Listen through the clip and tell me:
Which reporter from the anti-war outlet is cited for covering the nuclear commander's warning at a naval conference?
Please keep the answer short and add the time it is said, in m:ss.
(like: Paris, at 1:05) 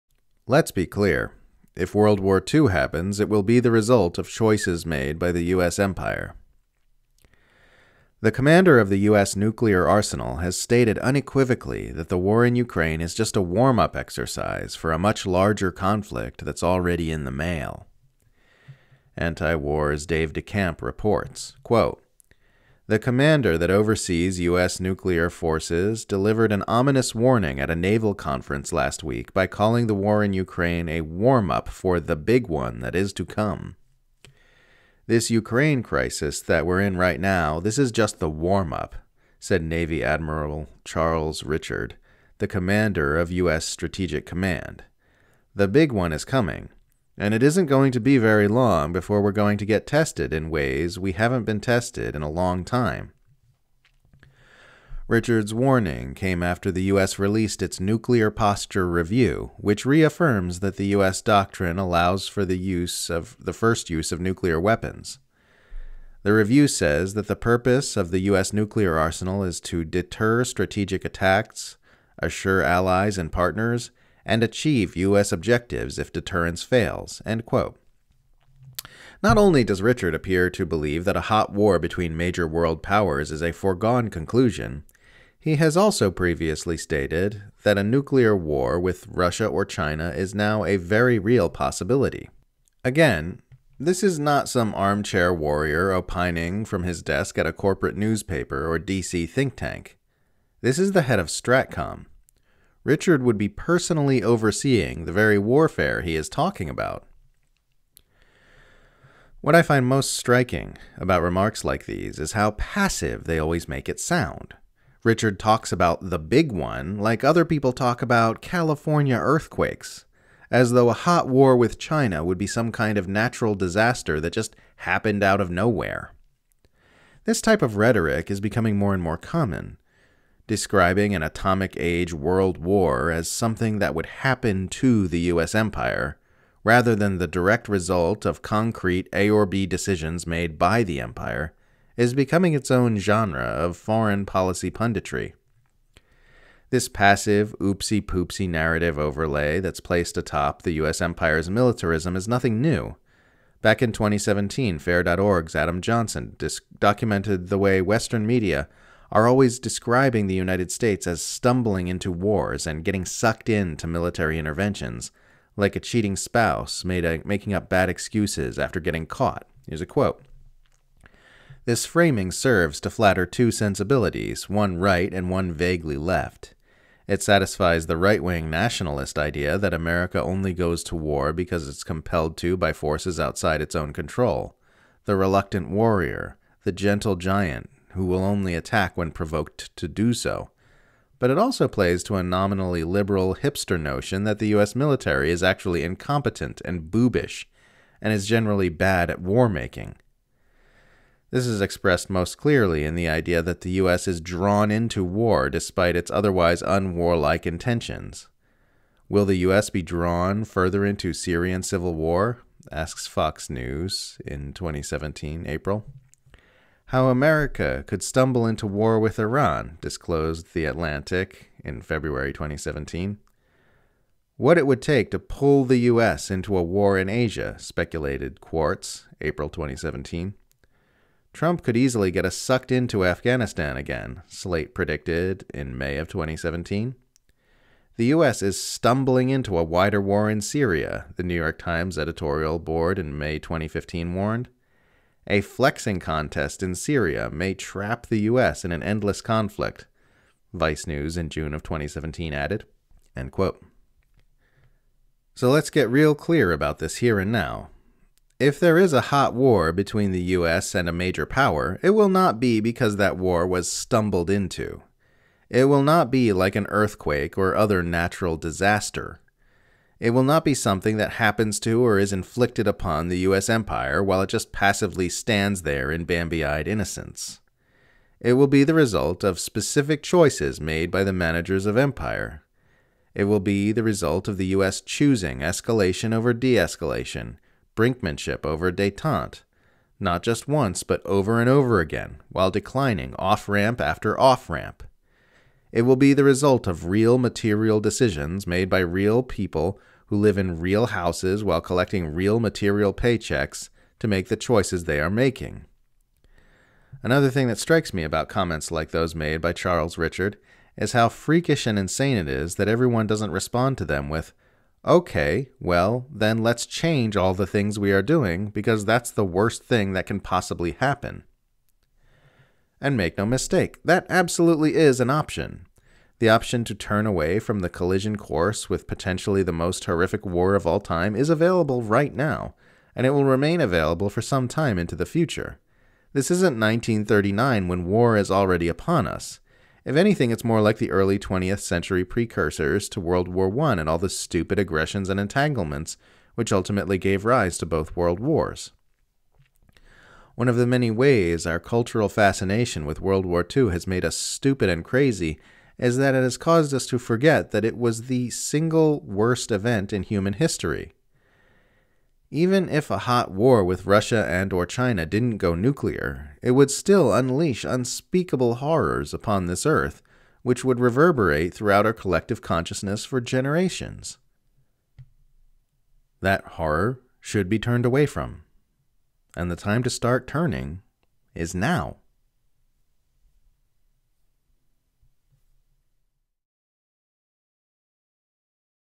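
Dave DeCamp, at 0:20.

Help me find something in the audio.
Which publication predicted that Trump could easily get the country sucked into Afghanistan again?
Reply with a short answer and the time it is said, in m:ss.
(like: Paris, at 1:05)
Slate, at 3:54.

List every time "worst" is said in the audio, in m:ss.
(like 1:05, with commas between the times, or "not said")
5:19, 5:59.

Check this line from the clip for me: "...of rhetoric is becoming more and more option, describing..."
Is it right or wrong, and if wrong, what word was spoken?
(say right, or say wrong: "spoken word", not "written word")
wrong: "common", not "option".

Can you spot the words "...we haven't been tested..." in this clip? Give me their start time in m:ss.
0:50.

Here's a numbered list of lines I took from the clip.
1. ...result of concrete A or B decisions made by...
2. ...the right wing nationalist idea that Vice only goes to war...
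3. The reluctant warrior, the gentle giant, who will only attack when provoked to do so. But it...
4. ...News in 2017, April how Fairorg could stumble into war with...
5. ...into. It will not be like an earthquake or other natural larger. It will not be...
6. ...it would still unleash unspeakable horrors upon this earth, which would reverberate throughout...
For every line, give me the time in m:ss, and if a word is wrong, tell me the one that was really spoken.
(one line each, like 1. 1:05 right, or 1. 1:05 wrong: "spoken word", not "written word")
1. 2:17 right
2. 2:57 wrong: "America", not "Vice"
3. 3:05 right
4. 3:33 wrong: "America", not "Fairorg"
5. 4:24 wrong: "disaster", not "larger"
6. 6:06 right.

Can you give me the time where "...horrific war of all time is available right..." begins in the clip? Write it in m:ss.
5:29.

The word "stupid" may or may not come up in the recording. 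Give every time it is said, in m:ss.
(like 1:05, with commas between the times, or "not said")
5:44, 5:54.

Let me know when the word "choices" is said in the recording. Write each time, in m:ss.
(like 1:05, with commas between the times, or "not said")
0:04, 4:40, 5:04.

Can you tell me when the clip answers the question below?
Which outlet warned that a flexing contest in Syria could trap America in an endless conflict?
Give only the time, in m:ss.
4:10.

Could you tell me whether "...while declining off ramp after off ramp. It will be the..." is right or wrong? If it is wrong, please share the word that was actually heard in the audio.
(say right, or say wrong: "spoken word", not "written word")
right.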